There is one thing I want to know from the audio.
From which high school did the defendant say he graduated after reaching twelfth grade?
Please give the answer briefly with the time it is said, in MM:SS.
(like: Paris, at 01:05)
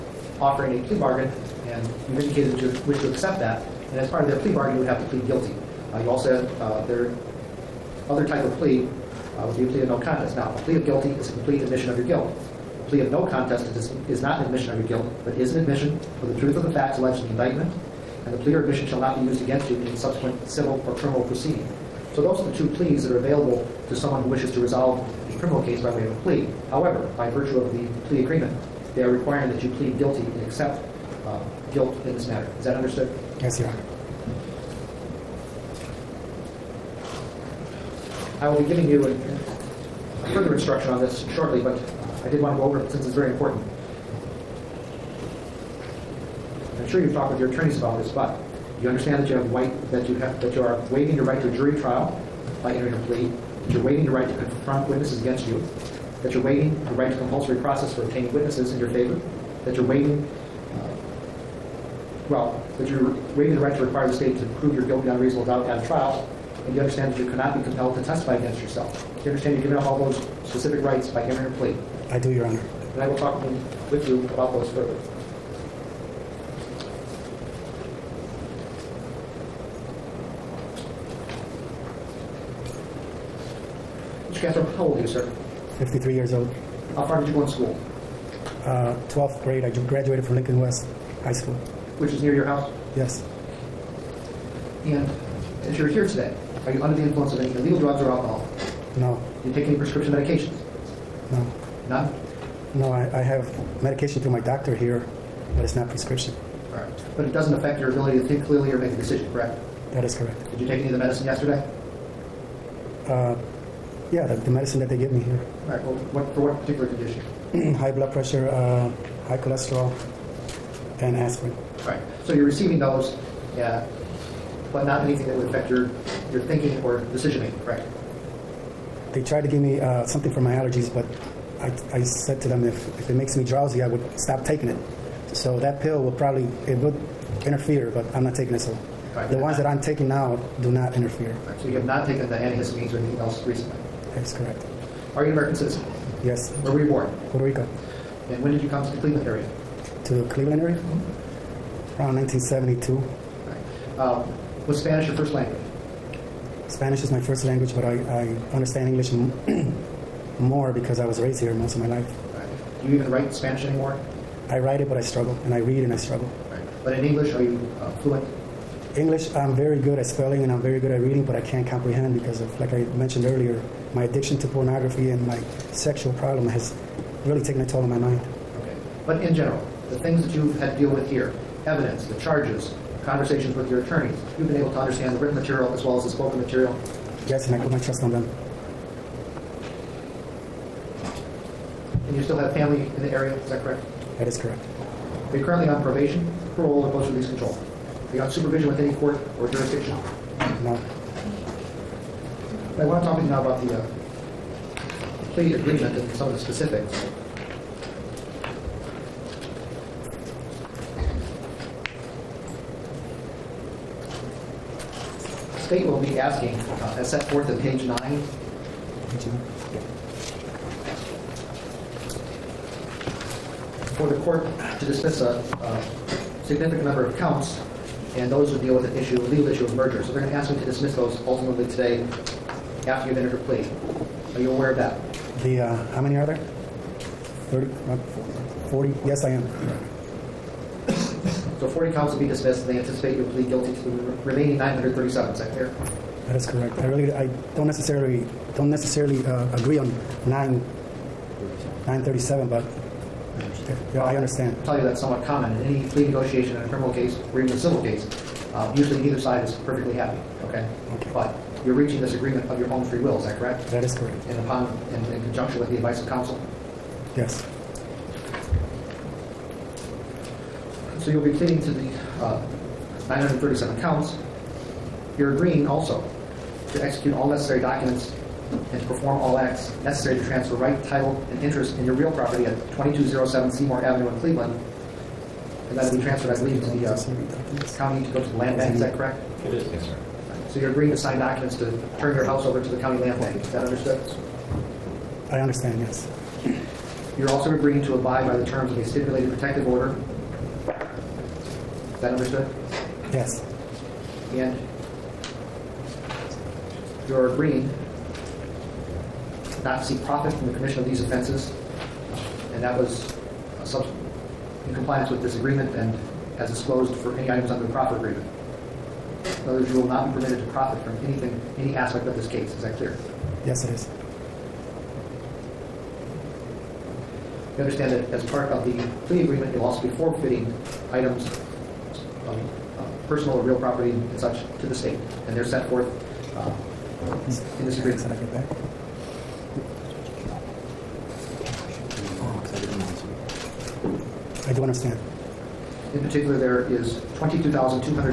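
Lincoln West, at 01:30.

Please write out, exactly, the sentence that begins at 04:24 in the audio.
And upon in, in conjunction with the advice of counsel.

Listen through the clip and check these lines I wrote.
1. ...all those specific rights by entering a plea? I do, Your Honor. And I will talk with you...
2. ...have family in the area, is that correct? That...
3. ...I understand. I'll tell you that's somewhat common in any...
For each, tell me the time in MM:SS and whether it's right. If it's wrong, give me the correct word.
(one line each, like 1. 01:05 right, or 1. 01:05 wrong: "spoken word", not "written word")
1. 01:09 right
2. 03:12 right
3. 04:14 right.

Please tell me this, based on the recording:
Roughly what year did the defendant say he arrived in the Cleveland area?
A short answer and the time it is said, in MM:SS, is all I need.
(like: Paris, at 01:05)
1972, at 02:32.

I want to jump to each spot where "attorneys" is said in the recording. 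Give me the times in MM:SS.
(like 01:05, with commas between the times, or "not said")
00:47, 03:03.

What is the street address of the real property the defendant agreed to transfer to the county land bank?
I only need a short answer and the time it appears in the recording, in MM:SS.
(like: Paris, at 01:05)
2207 Seymour Avenue, at 04:42.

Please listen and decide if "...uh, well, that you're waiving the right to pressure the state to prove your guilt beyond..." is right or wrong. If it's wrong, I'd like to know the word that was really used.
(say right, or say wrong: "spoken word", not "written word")
wrong: "require", not "pressure".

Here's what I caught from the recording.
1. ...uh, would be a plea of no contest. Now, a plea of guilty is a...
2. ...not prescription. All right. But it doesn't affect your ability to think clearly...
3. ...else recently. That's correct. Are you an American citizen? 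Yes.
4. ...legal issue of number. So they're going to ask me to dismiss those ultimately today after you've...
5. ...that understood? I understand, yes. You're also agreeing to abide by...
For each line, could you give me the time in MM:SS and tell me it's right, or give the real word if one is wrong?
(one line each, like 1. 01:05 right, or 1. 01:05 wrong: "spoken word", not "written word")
1. 00:09 right
2. 01:45 right
3. 02:23 right
4. 03:49 wrong: "merger", not "number"
5. 04:53 right.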